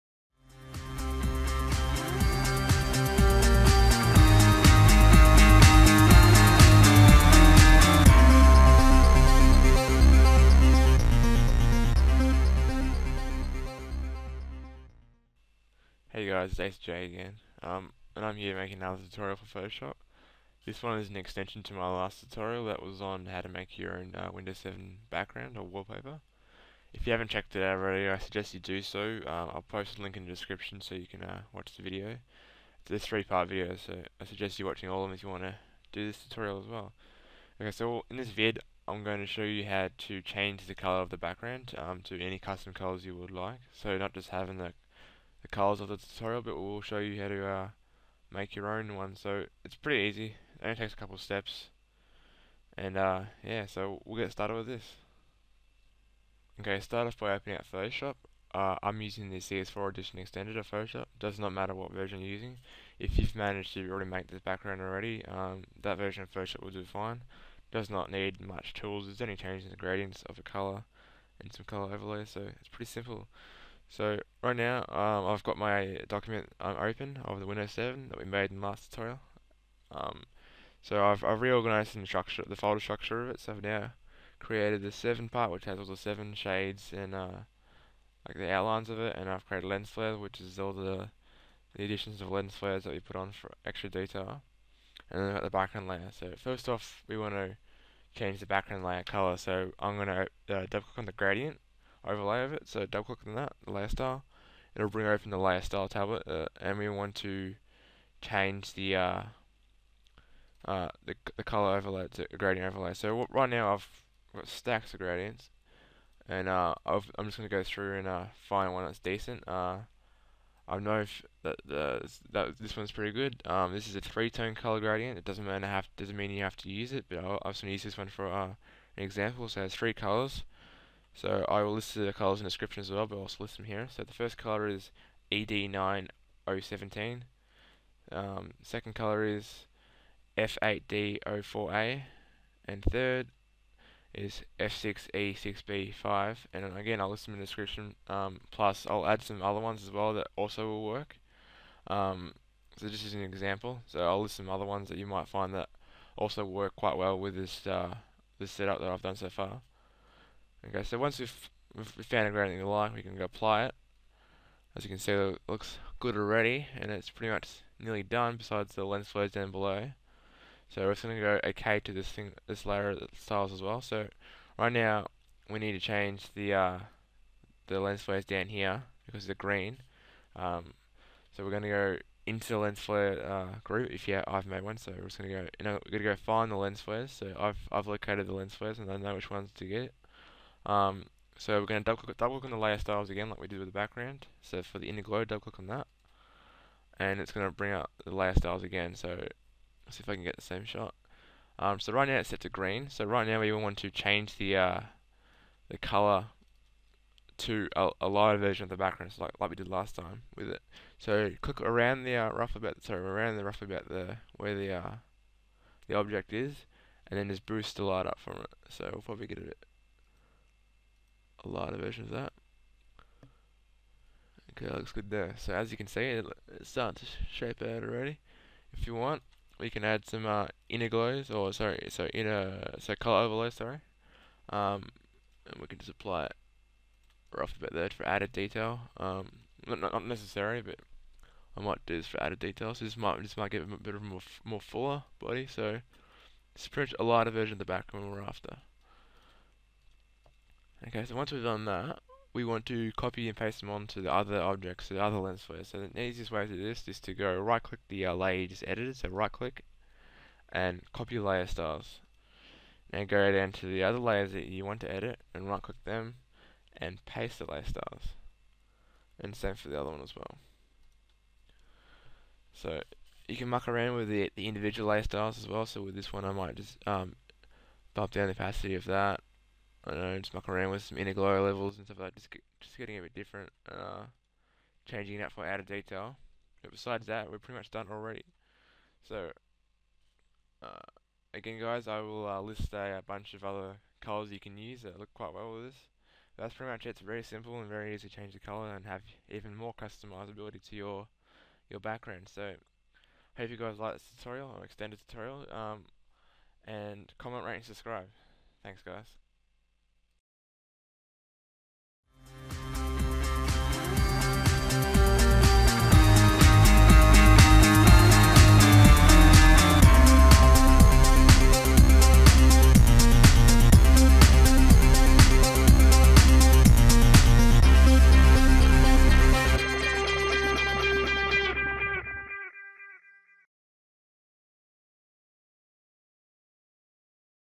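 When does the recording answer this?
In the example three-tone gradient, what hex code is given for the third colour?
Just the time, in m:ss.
2:24.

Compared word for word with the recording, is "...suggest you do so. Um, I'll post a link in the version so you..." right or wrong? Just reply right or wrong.
wrong.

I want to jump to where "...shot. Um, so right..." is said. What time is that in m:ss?
3:20.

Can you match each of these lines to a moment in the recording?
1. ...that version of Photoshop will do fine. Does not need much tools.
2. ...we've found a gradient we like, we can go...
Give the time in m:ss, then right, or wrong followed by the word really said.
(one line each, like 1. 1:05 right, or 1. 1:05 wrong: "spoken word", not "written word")
1. 1:05 right
2. 2:41 right.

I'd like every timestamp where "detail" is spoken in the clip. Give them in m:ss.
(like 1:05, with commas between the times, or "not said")
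1:33, 3:58, 4:02, 4:45.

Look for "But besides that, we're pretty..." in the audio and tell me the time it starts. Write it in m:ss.
4:46.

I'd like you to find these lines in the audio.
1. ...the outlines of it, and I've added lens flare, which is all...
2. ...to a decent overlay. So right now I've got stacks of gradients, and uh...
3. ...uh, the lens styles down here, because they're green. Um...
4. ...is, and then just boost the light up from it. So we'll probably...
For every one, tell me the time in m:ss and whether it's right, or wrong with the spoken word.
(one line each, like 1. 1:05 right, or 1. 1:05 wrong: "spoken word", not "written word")
1. 1:28 wrong: "created", not "added"
2. 1:52 wrong: "gradient", not "decent"
3. 2:56 wrong: "flares", not "styles"
4. 3:36 right.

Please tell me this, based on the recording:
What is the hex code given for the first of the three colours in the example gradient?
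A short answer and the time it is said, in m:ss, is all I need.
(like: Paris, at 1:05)
ED9017, at 2:15.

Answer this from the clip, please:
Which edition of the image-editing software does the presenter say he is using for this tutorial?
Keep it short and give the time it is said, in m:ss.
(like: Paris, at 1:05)
CS4 Edition Extended, at 0:59.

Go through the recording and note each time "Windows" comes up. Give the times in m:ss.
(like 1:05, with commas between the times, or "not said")
0:24, 1:17.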